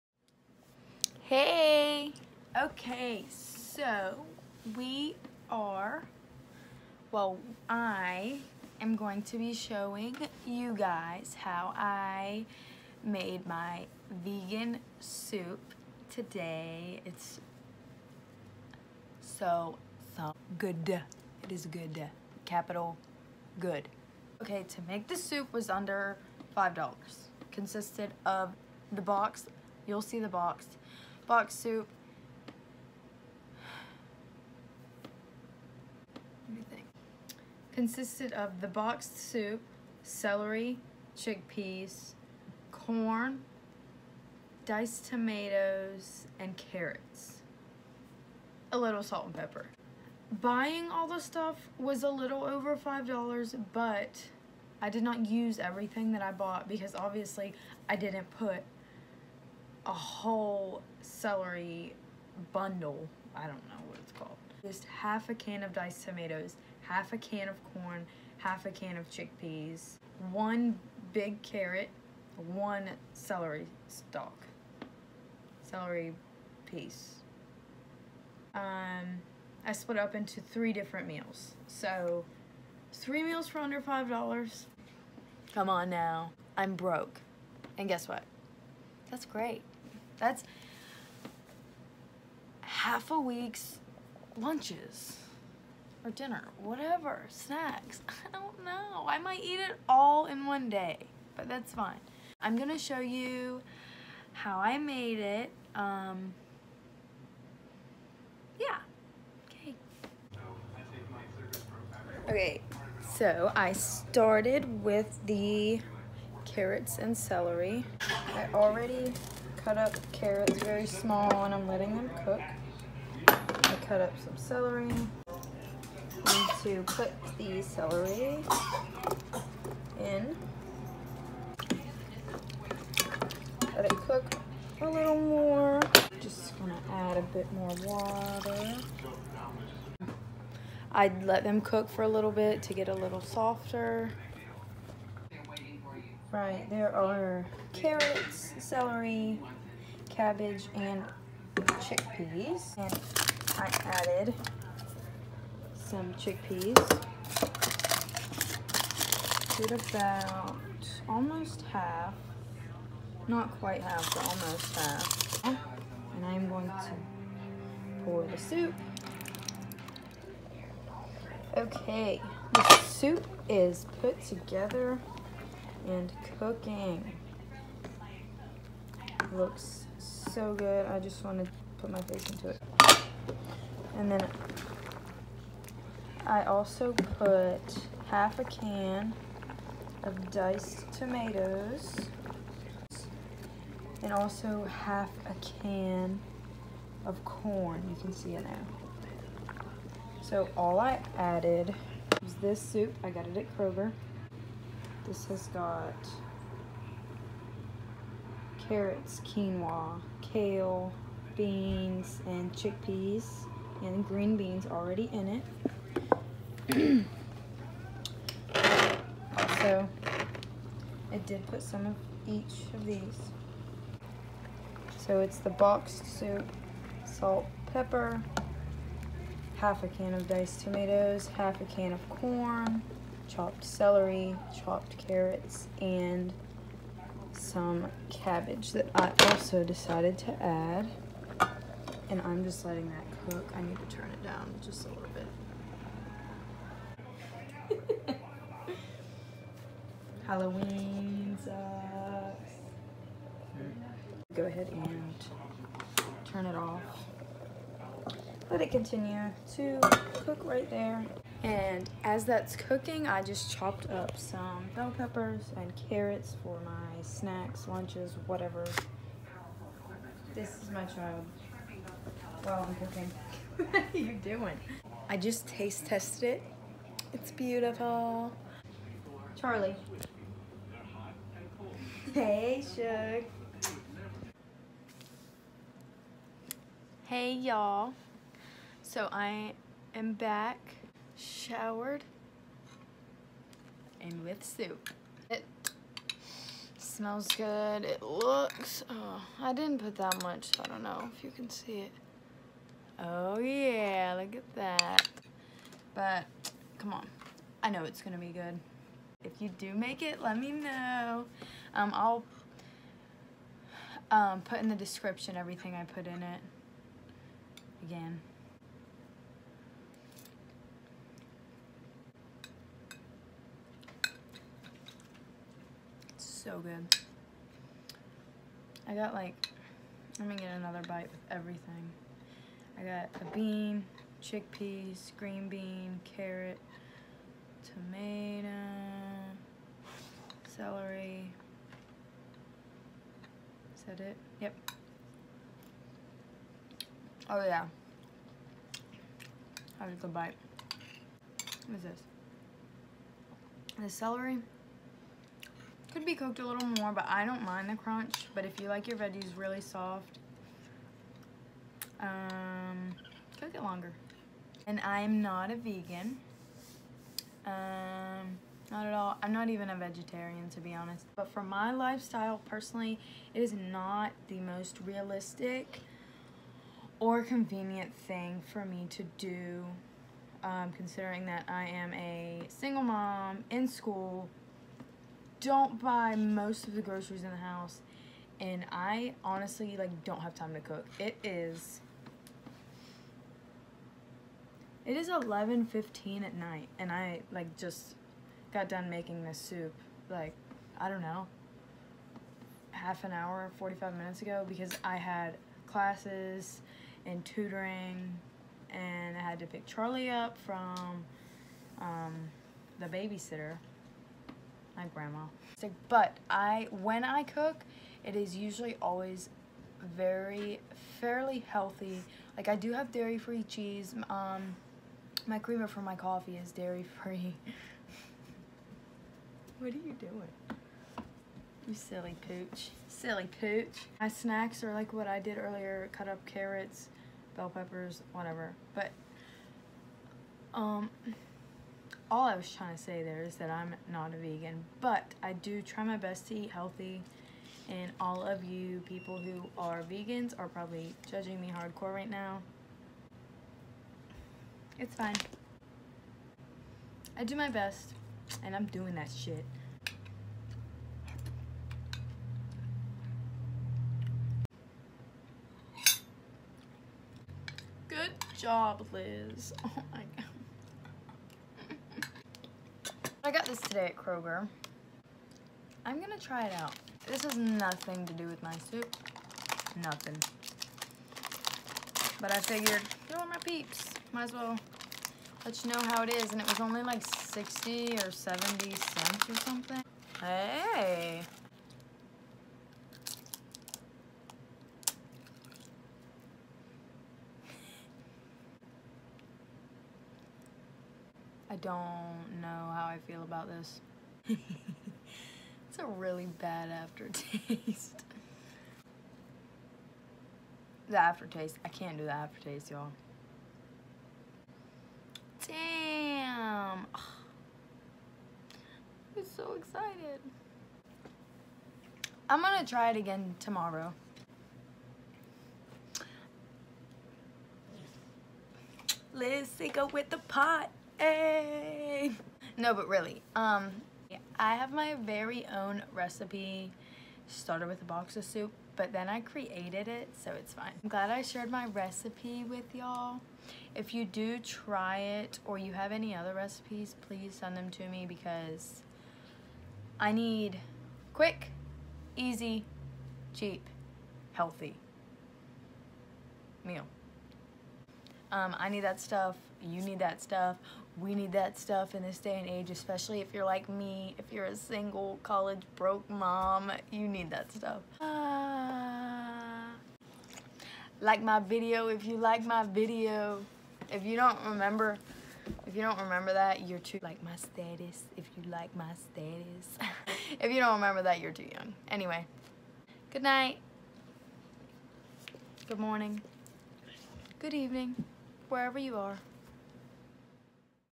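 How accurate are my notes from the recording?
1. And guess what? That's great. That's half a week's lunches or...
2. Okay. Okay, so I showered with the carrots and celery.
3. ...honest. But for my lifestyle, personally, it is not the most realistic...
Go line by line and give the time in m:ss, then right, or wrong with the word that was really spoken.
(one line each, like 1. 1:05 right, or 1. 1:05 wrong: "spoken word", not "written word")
1. 1:27 right
2. 1:49 wrong: "started", not "showered"
3. 6:10 right.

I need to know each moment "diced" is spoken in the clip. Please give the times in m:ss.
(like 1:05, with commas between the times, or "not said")
0:44, 1:05, 3:10, 3:50.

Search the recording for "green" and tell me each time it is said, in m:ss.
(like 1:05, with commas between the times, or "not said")
3:34, 5:35.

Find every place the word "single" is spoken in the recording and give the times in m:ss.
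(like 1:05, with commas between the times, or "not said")
6:22, 9:24.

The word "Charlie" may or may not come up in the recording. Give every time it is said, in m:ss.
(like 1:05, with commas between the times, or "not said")
4:39, 6:49.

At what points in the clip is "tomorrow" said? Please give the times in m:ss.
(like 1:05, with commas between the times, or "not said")
8:43.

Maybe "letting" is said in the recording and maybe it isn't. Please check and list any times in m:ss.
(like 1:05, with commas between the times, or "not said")
2:01, 4:02.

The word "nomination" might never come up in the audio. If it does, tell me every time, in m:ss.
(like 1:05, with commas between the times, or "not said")
not said.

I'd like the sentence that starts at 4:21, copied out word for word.
And as that's cooking, I just chopped up some bell peppers and carrots for my snacks, lunches, whatever.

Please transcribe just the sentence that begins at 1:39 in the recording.
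I might eat it all in one day, but that's fine.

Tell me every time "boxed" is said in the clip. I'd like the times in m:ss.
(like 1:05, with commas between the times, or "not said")
0:38, 3:45.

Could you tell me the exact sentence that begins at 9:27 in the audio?
Uh, like my video if you like my video.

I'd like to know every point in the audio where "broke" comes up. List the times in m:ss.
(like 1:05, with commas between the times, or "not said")
1:26, 9:25.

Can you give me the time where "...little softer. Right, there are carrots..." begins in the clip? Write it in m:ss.
2:22.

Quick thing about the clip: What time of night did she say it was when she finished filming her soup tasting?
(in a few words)
11:15.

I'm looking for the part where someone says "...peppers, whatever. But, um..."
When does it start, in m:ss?
7:17.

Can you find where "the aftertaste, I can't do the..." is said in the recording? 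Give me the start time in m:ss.
8:30.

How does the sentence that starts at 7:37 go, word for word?
I do my best, and I'm doing that shit.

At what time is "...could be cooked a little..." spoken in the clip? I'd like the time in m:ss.
5:55.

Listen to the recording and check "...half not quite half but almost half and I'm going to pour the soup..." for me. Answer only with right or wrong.
right.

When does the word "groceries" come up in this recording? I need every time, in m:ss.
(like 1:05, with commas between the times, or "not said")
6:26.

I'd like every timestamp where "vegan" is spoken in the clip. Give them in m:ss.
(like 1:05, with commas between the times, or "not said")
0:14, 6:05, 7:24, 7:29.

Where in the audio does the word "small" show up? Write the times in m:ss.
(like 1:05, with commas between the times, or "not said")
2:00.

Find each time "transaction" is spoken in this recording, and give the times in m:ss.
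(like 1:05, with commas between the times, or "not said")
not said.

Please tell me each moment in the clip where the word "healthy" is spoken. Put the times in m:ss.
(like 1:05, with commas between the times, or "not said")
7:01, 7:26, 9:14.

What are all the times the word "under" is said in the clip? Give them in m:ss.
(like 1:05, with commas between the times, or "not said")
0:25, 1:23.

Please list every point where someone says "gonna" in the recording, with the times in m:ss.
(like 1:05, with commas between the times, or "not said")
2:16, 5:08, 7:56, 8:42.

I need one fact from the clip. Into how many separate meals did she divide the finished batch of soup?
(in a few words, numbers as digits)
3.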